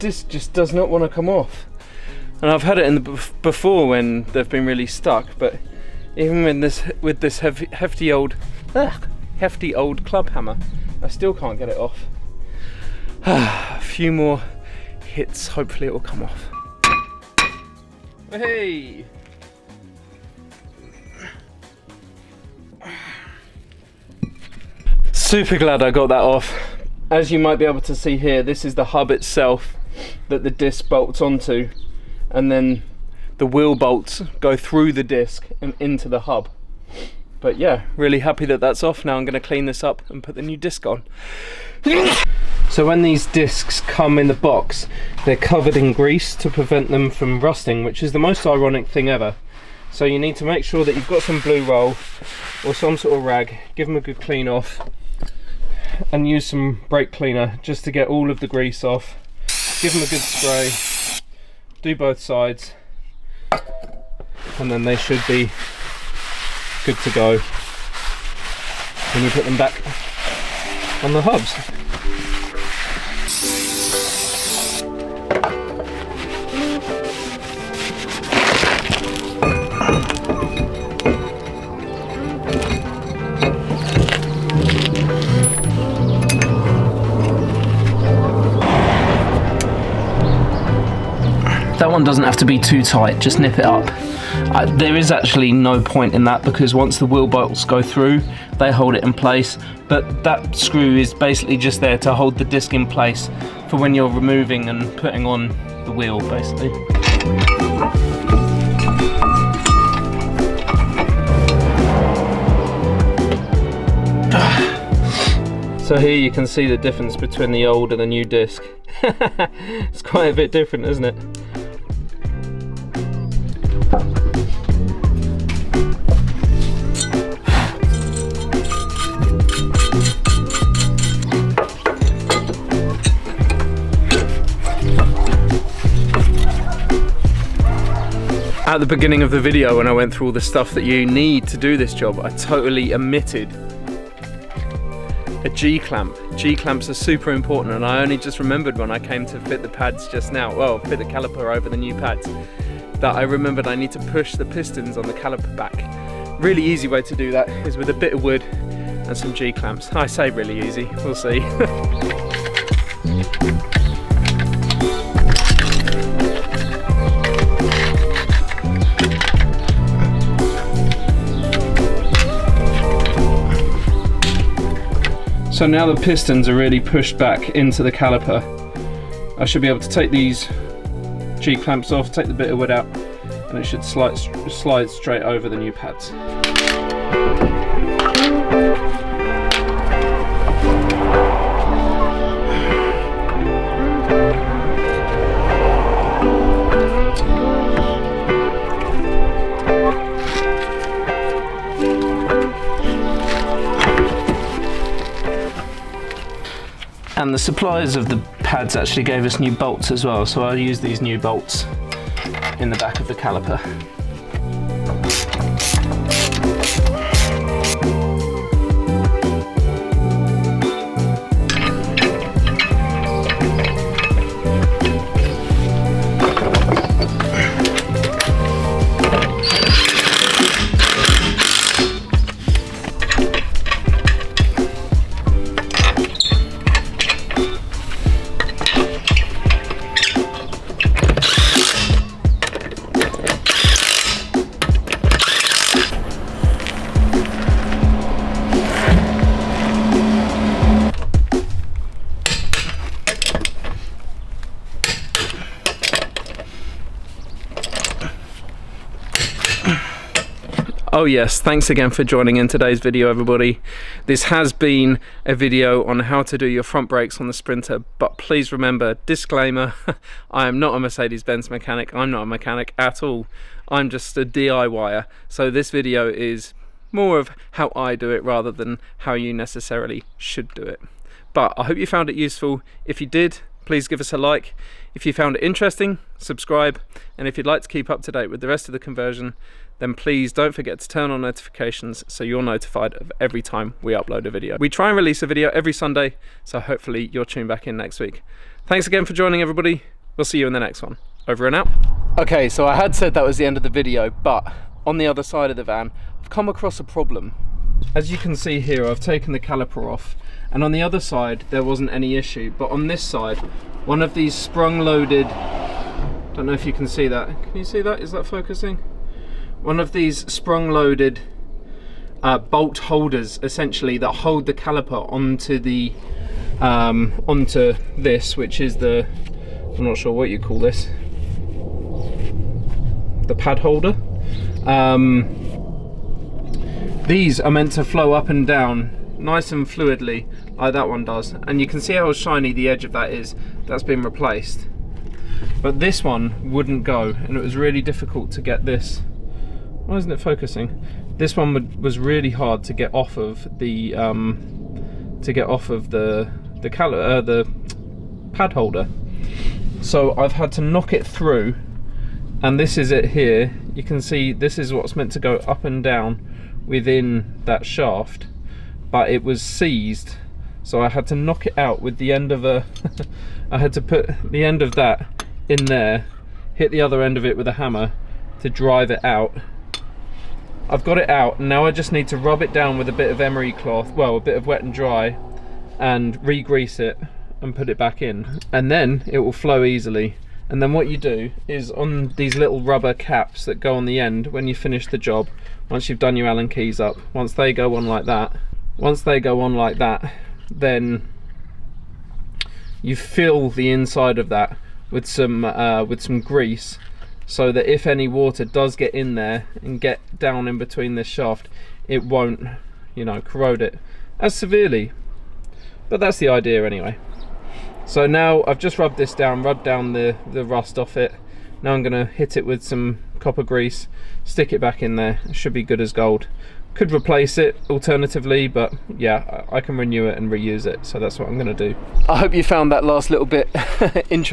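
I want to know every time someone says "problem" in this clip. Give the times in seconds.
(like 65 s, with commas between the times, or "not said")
306 s.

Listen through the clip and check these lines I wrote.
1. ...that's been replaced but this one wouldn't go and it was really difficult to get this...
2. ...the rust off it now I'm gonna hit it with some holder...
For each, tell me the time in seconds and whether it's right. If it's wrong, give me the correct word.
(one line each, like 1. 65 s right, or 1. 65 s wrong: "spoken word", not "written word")
1. 343 s right
2. 420 s wrong: "copper", not "holder".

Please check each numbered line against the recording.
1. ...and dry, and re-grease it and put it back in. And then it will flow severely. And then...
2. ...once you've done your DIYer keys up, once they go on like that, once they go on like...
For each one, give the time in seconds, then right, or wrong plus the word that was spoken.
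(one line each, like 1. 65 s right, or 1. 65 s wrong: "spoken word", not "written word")
1. 384 s wrong: "easily", not "severely"
2. 395 s wrong: "Allen", not "DIYer".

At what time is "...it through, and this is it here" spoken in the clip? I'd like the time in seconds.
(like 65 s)
360 s.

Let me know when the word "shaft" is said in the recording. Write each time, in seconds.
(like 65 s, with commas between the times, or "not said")
367 s, 411 s.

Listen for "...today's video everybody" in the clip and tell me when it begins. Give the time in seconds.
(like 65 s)
262 s.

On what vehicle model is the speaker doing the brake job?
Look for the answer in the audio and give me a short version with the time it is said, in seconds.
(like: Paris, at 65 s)
Sprinter, at 267 s.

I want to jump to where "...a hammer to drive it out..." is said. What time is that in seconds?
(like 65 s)
377 s.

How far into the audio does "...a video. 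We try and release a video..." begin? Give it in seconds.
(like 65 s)
294 s.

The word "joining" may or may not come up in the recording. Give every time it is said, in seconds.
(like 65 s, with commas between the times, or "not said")
262 s, 299 s.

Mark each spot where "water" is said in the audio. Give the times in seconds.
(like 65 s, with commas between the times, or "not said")
408 s.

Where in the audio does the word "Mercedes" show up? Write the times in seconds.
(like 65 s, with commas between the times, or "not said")
270 s.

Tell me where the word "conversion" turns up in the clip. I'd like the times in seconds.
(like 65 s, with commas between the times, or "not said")
288 s.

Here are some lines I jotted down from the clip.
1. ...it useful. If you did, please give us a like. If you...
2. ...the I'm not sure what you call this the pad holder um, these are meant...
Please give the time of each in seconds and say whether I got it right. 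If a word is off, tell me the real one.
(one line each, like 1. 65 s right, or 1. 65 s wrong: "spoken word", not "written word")
1. 282 s right
2. 328 s right.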